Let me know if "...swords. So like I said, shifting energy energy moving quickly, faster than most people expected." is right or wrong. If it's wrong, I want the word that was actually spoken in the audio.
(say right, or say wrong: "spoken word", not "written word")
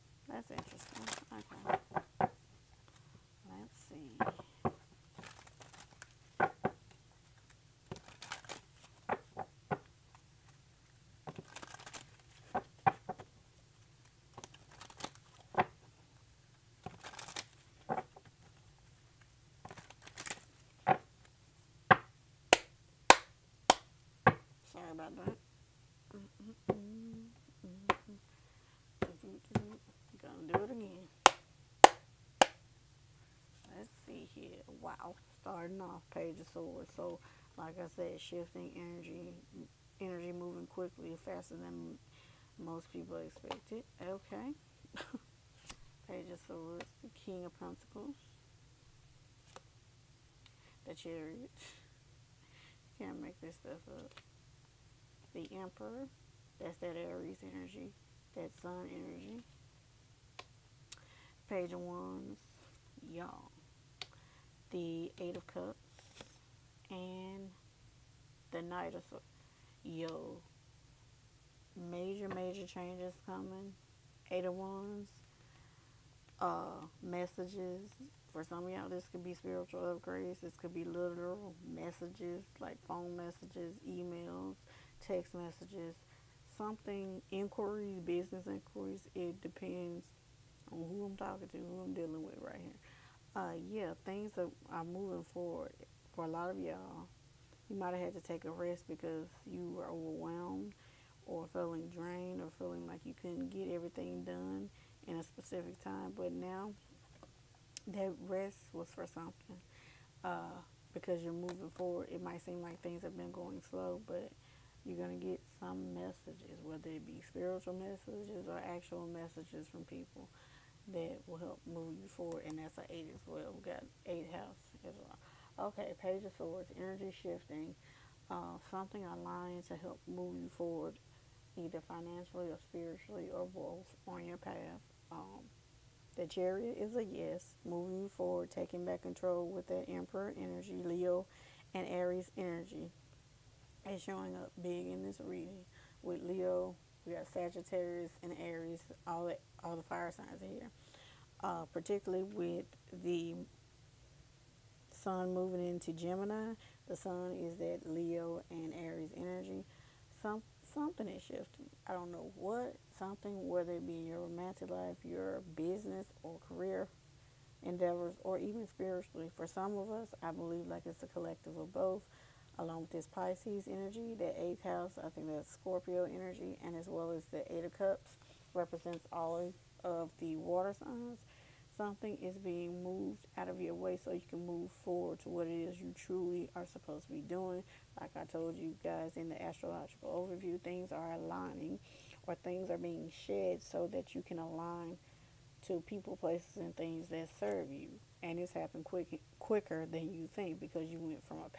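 right.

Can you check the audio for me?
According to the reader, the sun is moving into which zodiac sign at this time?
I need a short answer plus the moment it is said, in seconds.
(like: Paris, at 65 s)
Gemini, at 155 s.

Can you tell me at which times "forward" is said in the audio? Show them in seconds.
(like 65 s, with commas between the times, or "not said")
95 s, 111 s, 122 s, 130 s, 138 s, 184 s.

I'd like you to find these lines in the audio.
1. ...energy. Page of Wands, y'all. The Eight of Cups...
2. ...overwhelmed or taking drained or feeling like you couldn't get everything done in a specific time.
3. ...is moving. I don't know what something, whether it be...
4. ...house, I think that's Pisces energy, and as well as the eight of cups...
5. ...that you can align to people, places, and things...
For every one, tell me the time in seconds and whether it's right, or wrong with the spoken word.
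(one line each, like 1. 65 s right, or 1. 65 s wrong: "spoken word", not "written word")
1. 58 s right
2. 99 s wrong: "feeling", not "taking"
3. 161 s wrong: "shifting", not "moving"
4. 174 s wrong: "Scorpio", not "Pisces"
5. 193 s right.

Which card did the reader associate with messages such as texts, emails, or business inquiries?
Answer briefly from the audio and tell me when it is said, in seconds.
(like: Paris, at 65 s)
Eight of Wands, at 74 s.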